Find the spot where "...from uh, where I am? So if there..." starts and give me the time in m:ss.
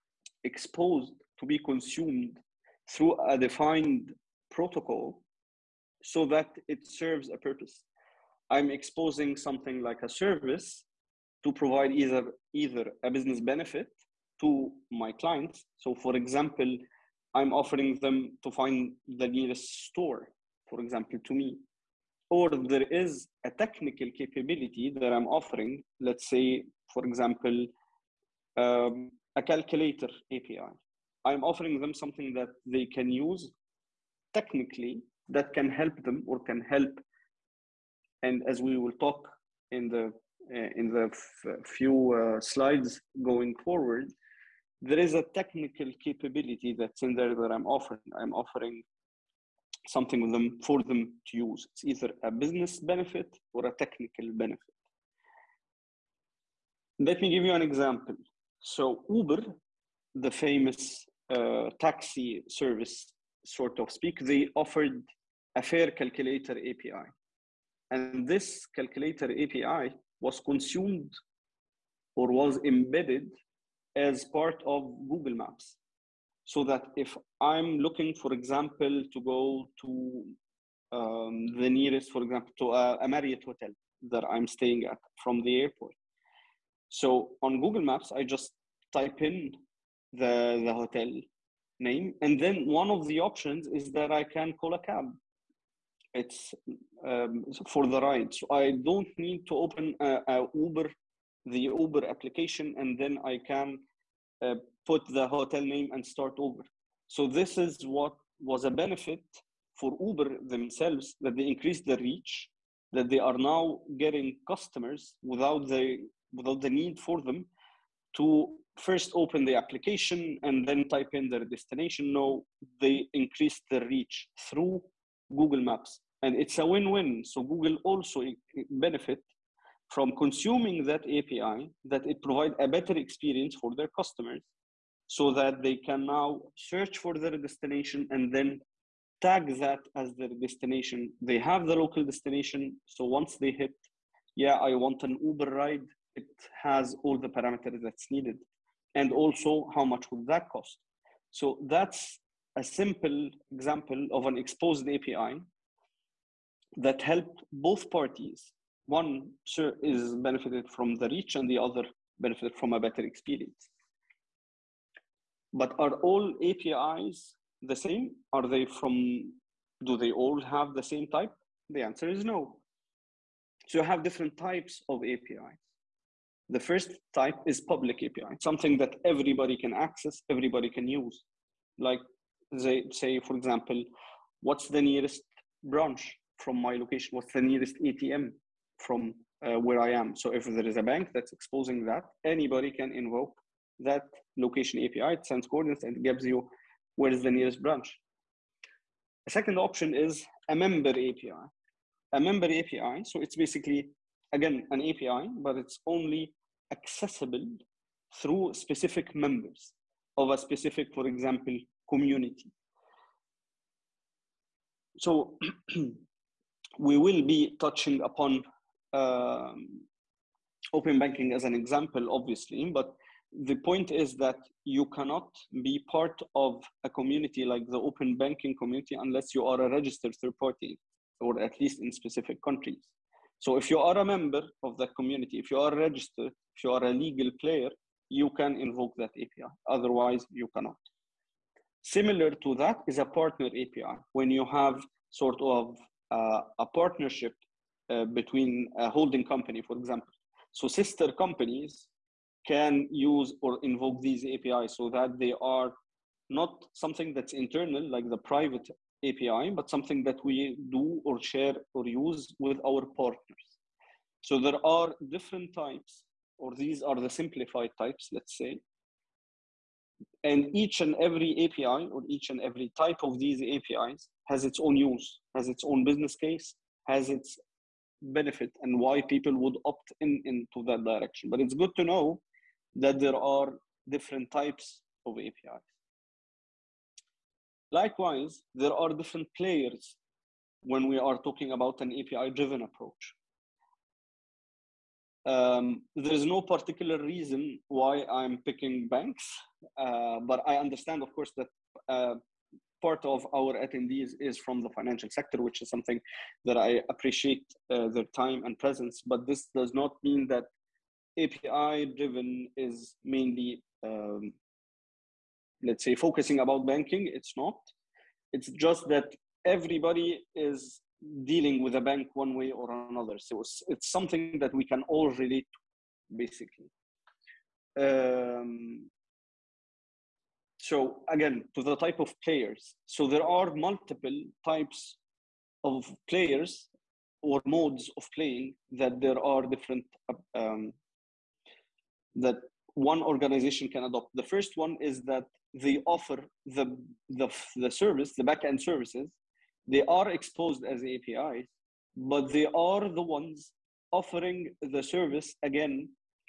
3:08.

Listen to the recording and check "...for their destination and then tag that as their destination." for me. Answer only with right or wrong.
right.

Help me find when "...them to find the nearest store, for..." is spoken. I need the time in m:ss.
0:18.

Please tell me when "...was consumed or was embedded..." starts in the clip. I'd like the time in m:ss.
1:10.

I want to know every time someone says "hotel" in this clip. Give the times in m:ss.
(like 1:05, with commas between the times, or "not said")
1:23, 1:30, 1:45.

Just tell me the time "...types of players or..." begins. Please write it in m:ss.
5:34.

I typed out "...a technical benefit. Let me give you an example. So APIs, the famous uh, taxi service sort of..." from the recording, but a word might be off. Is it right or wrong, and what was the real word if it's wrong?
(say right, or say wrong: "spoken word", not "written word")
wrong: "Uber", not "APIs".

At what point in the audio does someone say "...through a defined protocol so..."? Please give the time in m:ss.
0:02.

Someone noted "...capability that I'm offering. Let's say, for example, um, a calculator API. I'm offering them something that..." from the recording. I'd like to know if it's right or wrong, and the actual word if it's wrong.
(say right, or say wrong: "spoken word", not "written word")
right.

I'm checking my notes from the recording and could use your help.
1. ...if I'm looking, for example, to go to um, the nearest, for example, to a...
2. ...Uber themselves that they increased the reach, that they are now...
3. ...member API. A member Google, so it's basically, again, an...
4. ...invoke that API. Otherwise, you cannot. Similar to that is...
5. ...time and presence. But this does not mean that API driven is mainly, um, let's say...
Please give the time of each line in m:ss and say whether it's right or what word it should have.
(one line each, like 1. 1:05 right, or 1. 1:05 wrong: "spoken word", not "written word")
1. 1:16 right
2. 1:50 right
3. 3:20 wrong: "API", not "Google"
4. 3:58 right
5. 5:08 right.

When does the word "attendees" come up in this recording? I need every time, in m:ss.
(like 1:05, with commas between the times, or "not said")
5:03.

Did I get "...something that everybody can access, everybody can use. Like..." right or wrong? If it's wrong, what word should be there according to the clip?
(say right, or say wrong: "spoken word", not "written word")
right.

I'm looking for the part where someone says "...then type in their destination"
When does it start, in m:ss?
2:00.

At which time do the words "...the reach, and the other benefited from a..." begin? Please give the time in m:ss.
2:40.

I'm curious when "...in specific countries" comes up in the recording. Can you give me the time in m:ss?
3:51.